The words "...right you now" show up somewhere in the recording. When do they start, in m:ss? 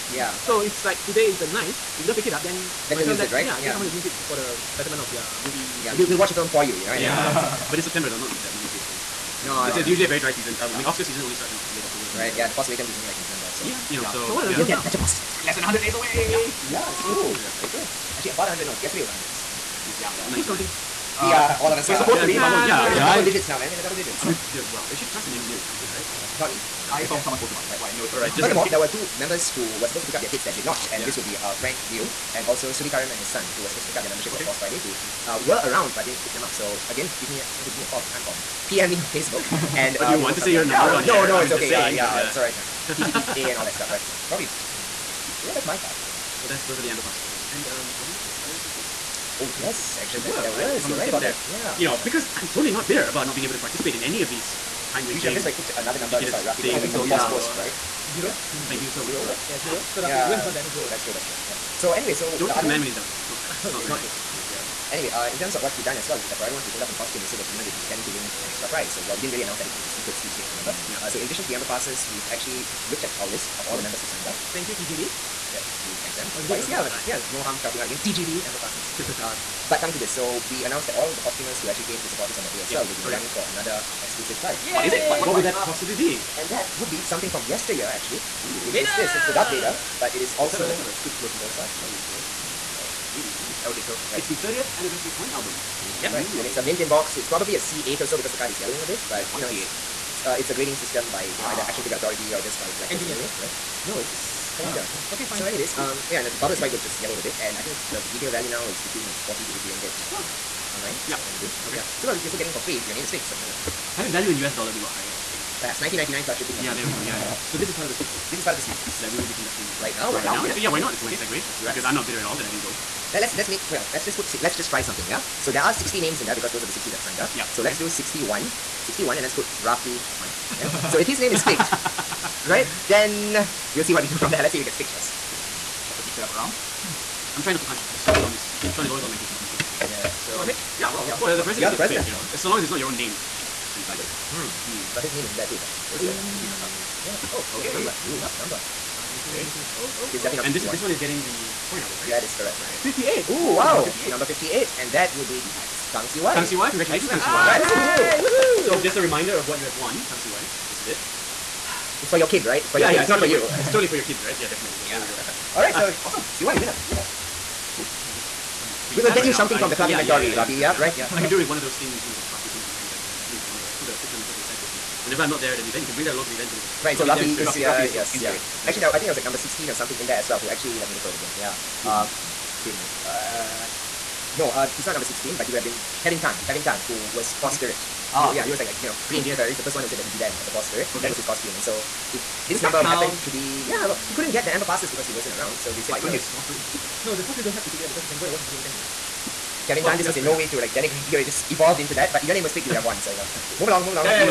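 2:49.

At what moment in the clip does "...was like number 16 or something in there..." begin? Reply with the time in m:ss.
2:59.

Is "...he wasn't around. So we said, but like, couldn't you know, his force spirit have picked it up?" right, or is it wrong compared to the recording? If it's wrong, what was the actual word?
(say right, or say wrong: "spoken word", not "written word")
right.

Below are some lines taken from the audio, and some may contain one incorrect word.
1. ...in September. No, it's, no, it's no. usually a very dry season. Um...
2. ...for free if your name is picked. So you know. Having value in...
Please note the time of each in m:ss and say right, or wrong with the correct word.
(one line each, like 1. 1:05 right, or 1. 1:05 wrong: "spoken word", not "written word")
1. 0:09 right
2. 1:52 right.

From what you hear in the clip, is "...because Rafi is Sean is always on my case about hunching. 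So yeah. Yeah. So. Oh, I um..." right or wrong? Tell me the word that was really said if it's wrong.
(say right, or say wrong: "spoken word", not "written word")
wrong: "Sean", not "Rafi".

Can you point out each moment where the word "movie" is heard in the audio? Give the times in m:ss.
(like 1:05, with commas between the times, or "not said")
0:05, 3:18.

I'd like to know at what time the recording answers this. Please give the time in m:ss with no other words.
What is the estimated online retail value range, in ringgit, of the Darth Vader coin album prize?
1:49.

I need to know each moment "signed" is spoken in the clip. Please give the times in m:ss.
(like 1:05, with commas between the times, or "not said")
1:14, 2:07.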